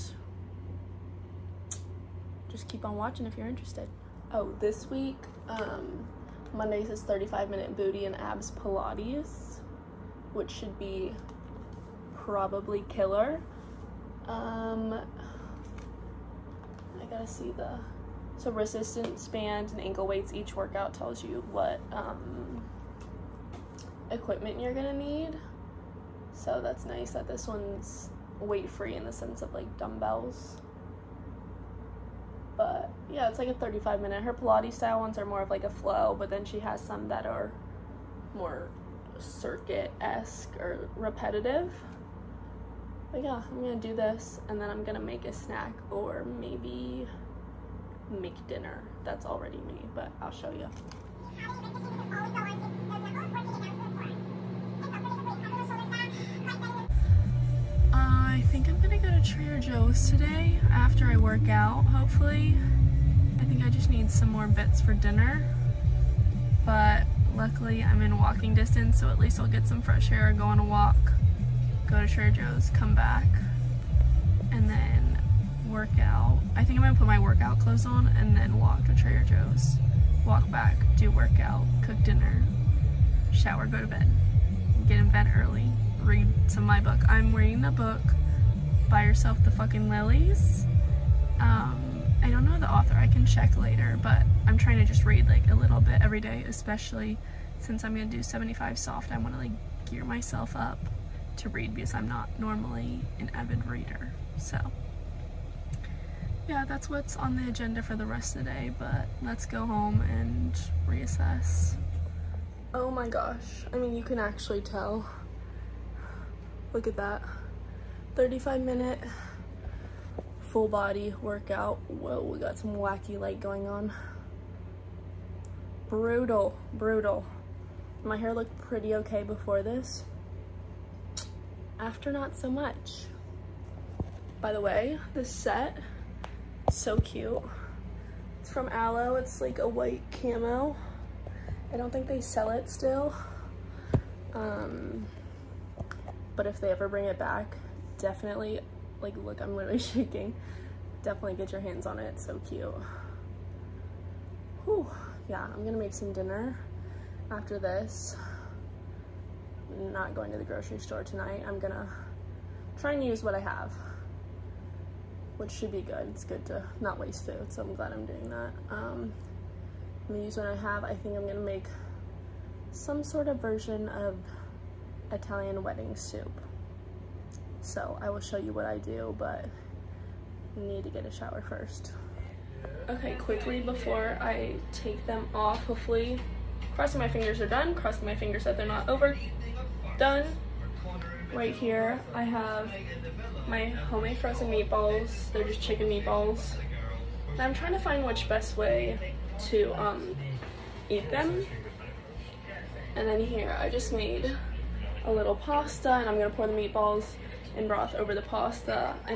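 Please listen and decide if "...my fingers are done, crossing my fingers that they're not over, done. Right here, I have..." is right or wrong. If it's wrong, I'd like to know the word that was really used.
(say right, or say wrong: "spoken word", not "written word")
right.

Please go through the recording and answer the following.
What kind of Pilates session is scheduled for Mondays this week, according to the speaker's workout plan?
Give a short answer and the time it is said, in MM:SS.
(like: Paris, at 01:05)
Booty and abs Pilates, at 00:07.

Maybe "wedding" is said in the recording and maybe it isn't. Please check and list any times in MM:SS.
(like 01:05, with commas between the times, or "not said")
02:55.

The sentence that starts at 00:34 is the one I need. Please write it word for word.
Her Pilates style ones are more of like a flow, but then she has some that are more circuit esque or repetitive.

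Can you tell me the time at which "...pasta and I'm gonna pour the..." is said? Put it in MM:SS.
03:25.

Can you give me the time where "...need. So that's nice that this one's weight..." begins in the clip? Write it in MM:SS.
00:24.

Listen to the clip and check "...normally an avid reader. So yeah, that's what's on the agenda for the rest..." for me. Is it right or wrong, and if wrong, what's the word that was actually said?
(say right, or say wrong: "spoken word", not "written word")
right.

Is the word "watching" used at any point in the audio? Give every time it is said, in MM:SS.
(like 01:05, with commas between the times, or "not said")
00:02.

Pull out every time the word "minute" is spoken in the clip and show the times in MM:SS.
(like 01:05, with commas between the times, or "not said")
00:07, 00:34, 01:58.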